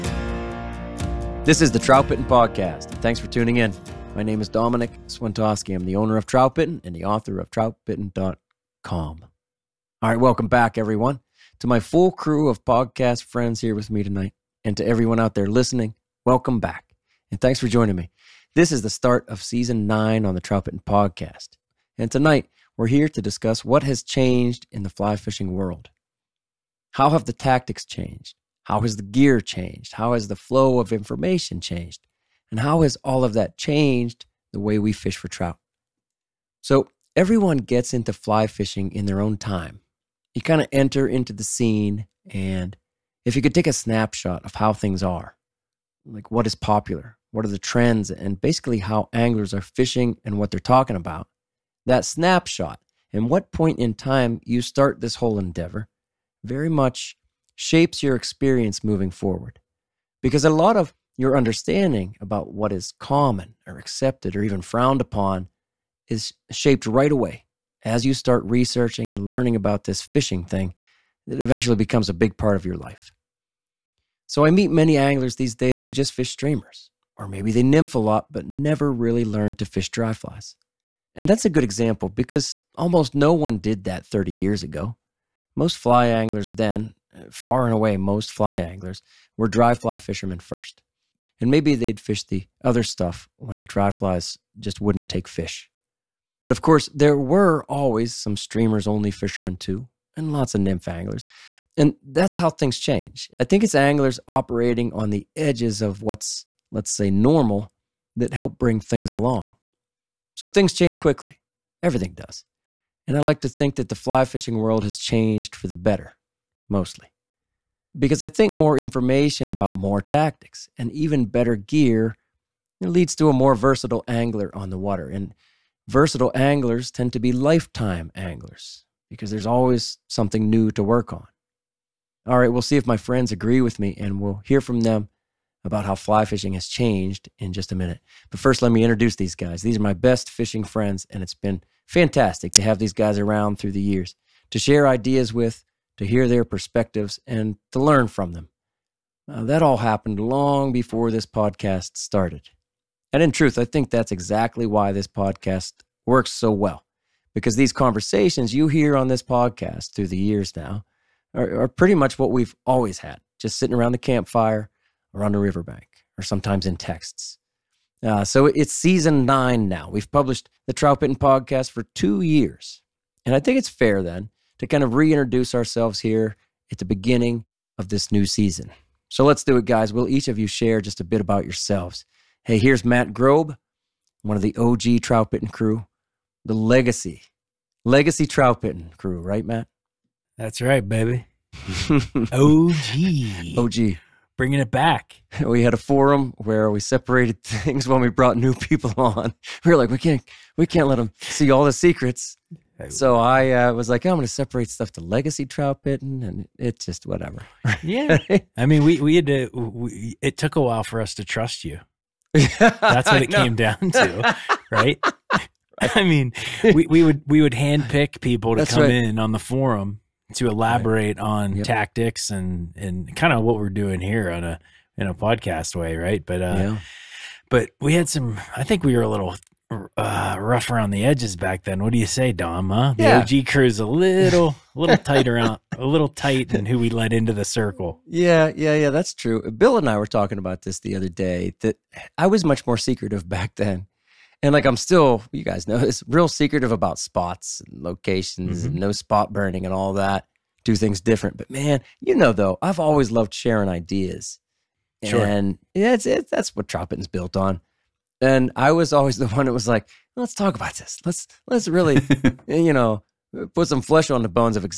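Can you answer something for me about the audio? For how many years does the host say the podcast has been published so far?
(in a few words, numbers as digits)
2.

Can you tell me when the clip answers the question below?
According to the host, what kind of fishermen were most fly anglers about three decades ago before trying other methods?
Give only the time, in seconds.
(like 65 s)
89 s.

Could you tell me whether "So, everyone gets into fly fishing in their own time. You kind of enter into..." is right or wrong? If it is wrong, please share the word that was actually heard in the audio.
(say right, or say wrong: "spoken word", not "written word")
right.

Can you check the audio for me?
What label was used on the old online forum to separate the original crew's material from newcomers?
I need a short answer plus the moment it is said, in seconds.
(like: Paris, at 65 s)
legacy trout bitten, at 204 s.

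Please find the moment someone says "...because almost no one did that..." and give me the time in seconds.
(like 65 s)
82 s.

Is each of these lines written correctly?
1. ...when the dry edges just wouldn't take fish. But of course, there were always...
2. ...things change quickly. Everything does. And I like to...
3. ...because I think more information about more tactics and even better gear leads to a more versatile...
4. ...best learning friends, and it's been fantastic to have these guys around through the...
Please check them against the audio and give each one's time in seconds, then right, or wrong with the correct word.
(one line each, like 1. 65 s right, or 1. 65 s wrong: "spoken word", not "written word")
1. 93 s wrong: "flies", not "edges"
2. 110 s right
3. 117 s right
4. 139 s wrong: "fishing", not "learning".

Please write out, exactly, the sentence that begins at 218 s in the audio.
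in on the forum to elaborate right.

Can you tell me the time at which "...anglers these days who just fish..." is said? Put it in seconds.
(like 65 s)
74 s.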